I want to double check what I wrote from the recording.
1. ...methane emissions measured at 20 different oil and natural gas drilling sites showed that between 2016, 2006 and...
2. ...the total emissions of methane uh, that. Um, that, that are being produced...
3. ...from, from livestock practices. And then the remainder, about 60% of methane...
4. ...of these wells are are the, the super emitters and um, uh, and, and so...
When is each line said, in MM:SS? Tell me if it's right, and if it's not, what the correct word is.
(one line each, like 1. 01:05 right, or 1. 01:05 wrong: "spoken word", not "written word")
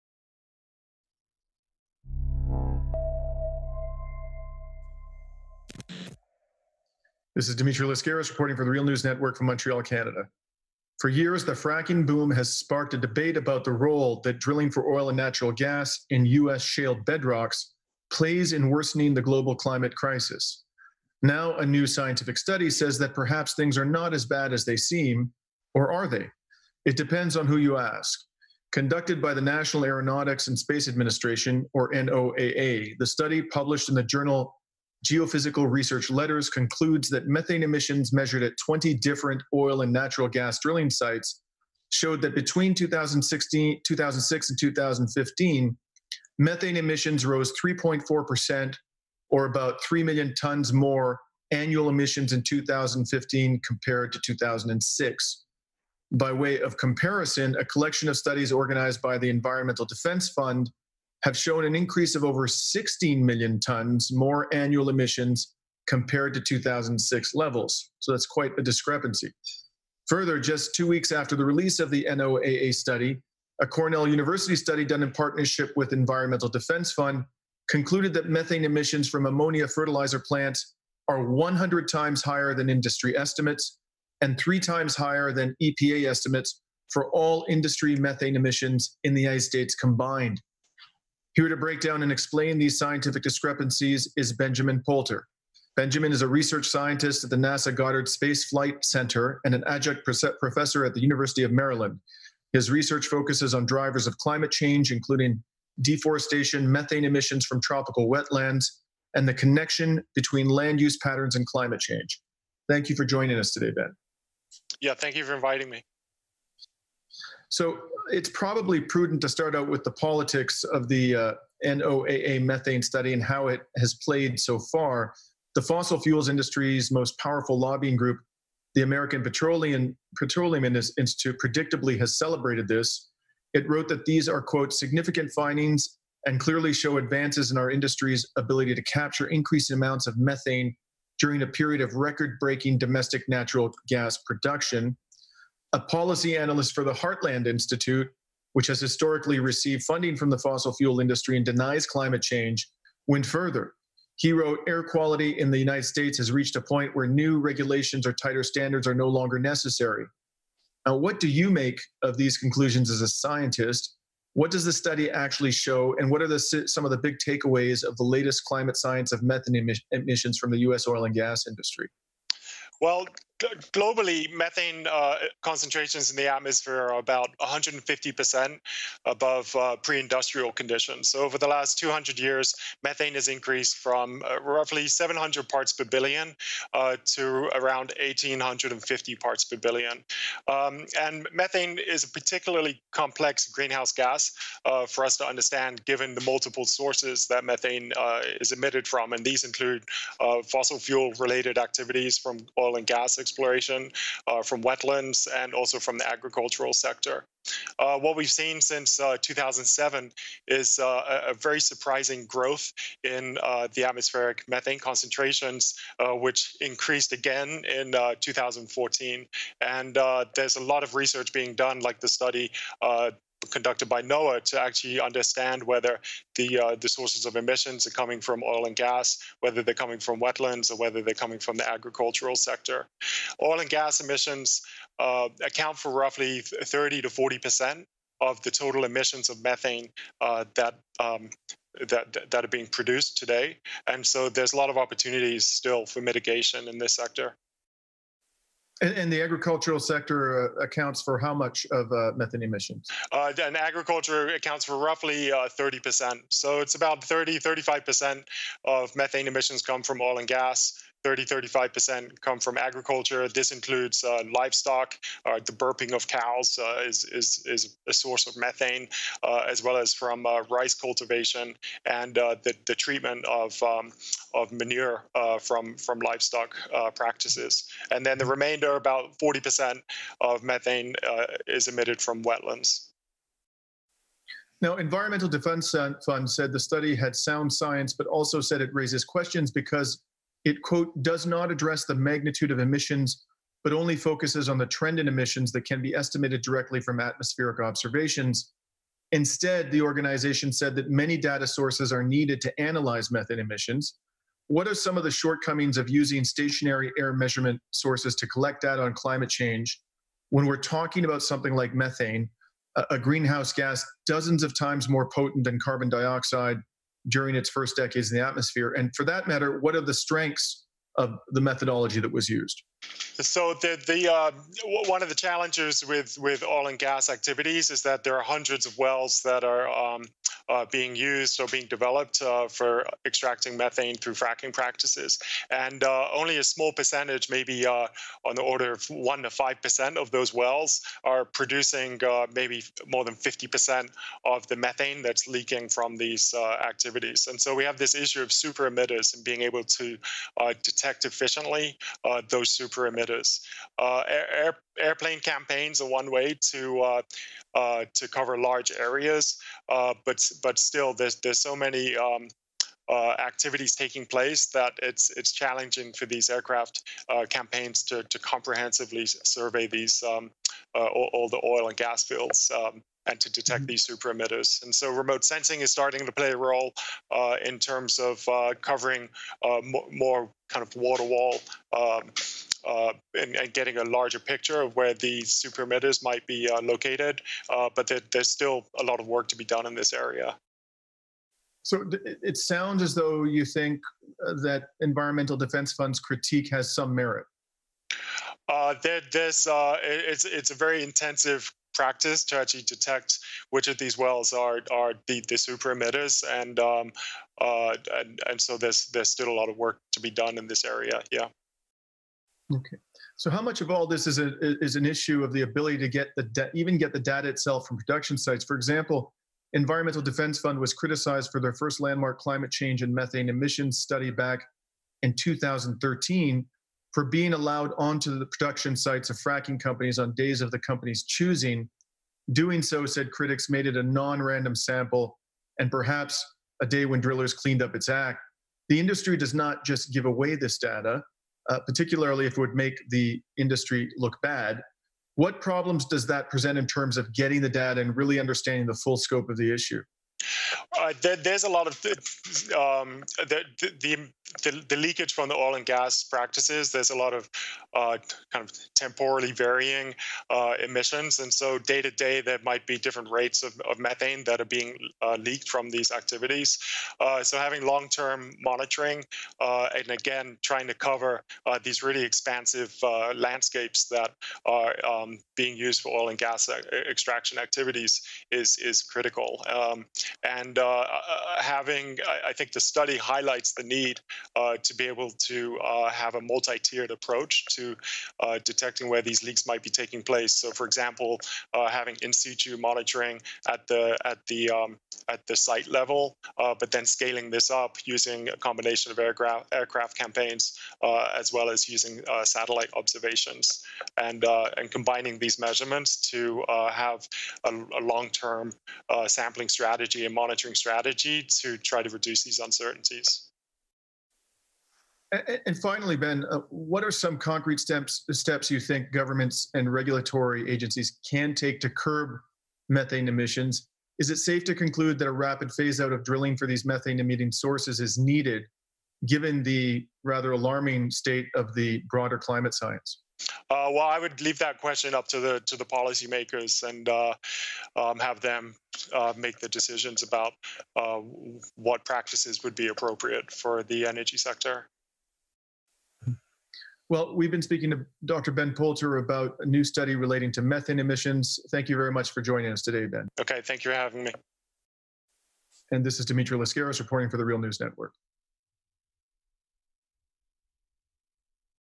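1. 00:37 right
2. 03:58 right
3. 04:35 wrong: "40", not "60"
4. 06:43 right.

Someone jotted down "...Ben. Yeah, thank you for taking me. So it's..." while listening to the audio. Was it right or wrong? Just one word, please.
wrong.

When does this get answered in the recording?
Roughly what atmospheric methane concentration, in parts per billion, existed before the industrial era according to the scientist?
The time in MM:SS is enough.
03:04.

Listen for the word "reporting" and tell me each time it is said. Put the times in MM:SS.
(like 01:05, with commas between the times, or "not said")
00:08, 09:16.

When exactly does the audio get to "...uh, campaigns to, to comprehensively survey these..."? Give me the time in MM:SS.
06:07.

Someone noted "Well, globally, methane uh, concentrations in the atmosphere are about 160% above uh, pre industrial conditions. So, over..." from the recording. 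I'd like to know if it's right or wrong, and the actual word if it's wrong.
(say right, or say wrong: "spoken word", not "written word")
wrong: "150", not "160".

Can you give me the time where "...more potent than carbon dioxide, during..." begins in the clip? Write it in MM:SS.
05:14.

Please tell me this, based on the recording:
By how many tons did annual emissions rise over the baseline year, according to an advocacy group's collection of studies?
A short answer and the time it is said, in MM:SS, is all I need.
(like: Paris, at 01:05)
16 million tons, at 01:02.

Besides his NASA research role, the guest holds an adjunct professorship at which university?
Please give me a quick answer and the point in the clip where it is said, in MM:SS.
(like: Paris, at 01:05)
University of Maryland, at 01:41.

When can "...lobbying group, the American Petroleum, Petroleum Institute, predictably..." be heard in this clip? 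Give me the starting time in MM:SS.
02:07.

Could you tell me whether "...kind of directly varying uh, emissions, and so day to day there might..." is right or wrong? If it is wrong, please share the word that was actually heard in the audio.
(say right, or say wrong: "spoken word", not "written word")
wrong: "temporally", not "directly".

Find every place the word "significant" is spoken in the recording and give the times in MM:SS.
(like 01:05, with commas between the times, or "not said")
02:14.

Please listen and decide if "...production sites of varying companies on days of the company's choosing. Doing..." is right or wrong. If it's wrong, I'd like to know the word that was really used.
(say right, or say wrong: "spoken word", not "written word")
wrong: "fracking", not "varying".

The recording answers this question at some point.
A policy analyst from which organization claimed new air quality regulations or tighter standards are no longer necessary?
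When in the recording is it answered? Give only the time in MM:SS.
02:26.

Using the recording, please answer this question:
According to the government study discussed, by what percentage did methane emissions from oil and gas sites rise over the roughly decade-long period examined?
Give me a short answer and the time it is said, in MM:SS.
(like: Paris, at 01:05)
3.4%, at 00:47.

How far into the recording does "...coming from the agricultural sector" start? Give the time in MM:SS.
03:51.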